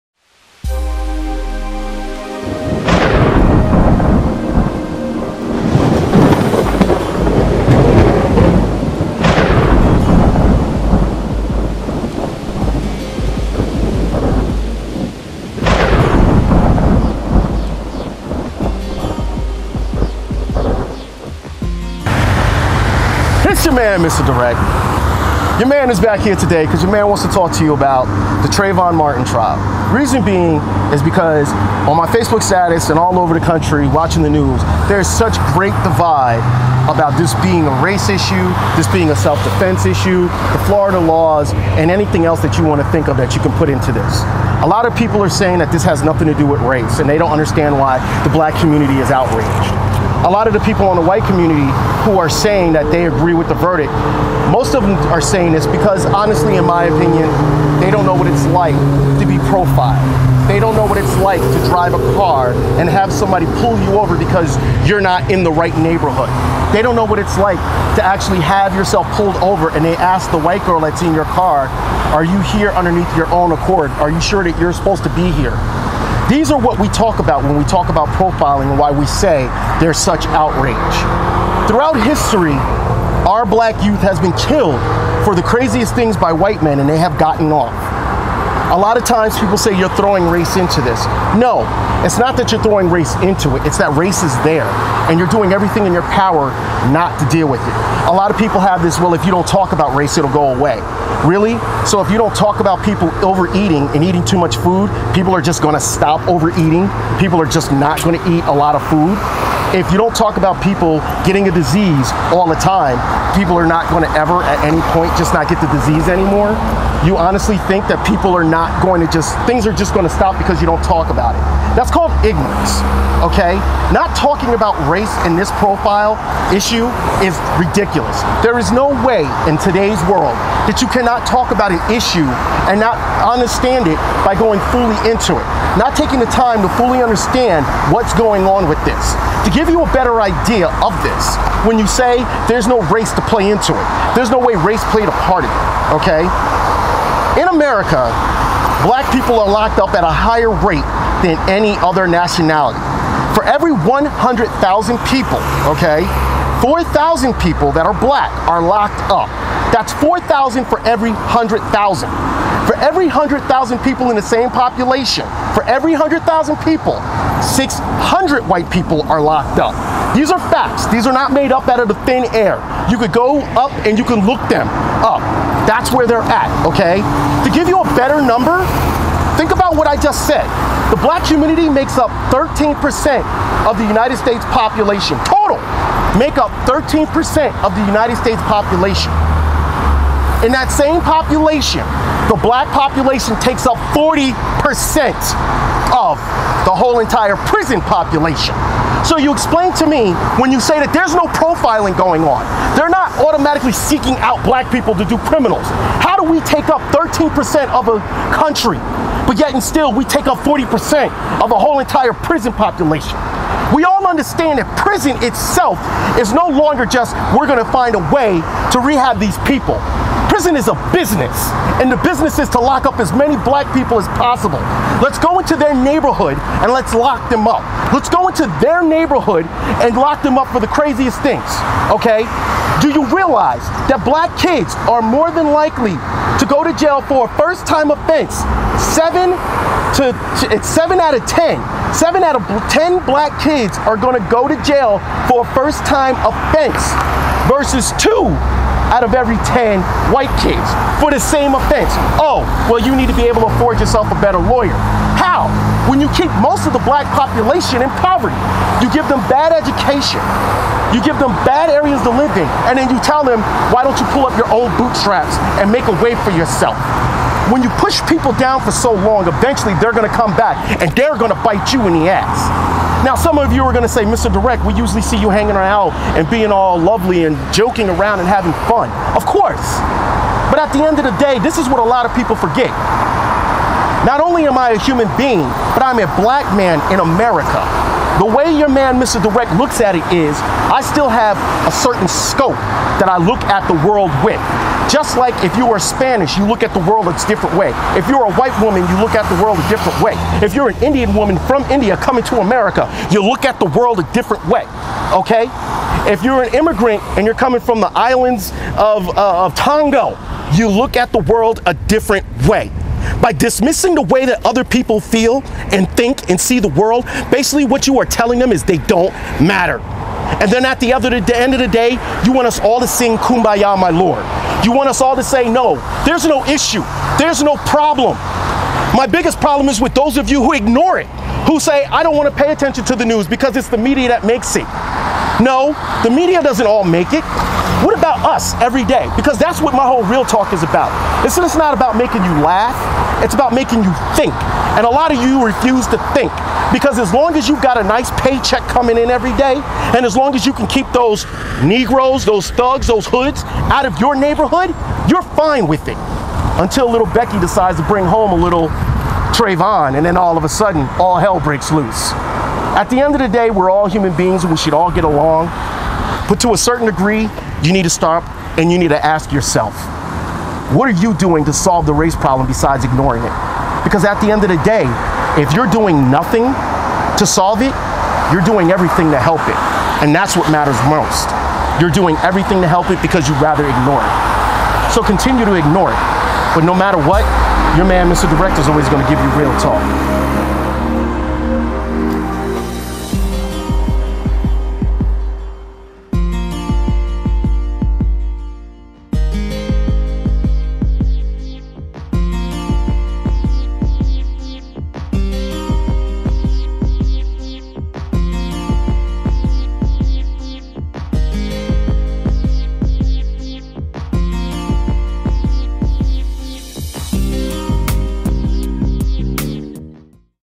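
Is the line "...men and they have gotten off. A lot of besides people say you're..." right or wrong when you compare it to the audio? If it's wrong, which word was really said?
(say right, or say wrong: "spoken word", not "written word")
wrong: "times", not "besides".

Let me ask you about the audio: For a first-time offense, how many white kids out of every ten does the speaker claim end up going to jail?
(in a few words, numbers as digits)
2.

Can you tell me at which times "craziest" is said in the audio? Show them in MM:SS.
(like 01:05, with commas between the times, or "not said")
01:25, 03:50.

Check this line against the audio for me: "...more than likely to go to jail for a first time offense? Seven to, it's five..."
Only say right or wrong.
wrong.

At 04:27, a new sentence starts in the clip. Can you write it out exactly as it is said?
When you push people down for so long, eventually they're gonna come back and they're gonna bite you in the ass.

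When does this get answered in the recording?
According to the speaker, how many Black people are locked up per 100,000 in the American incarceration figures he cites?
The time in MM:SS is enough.
02:36.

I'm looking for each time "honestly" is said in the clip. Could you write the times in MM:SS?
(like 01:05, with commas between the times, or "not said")
00:56, 01:57.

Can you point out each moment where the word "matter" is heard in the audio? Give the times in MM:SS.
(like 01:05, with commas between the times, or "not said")
05:19, 06:20, 06:26.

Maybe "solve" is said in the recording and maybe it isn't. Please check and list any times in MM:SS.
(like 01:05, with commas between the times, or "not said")
06:11, 06:17.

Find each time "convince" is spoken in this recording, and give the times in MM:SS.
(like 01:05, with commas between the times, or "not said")
not said.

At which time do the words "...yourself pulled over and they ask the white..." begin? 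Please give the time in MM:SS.
01:08.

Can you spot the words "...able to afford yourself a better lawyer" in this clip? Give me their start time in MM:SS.
04:13.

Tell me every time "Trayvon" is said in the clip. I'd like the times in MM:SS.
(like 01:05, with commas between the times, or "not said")
00:28, 05:59.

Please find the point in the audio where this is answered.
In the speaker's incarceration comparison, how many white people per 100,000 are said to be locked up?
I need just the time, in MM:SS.
02:47.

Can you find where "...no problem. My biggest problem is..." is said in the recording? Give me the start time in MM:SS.
05:27.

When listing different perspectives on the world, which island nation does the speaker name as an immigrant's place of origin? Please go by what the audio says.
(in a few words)
Tonga.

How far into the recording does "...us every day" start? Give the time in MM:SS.
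05:38.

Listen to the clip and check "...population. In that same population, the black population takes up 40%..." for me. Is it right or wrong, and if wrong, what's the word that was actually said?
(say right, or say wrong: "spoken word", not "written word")
right.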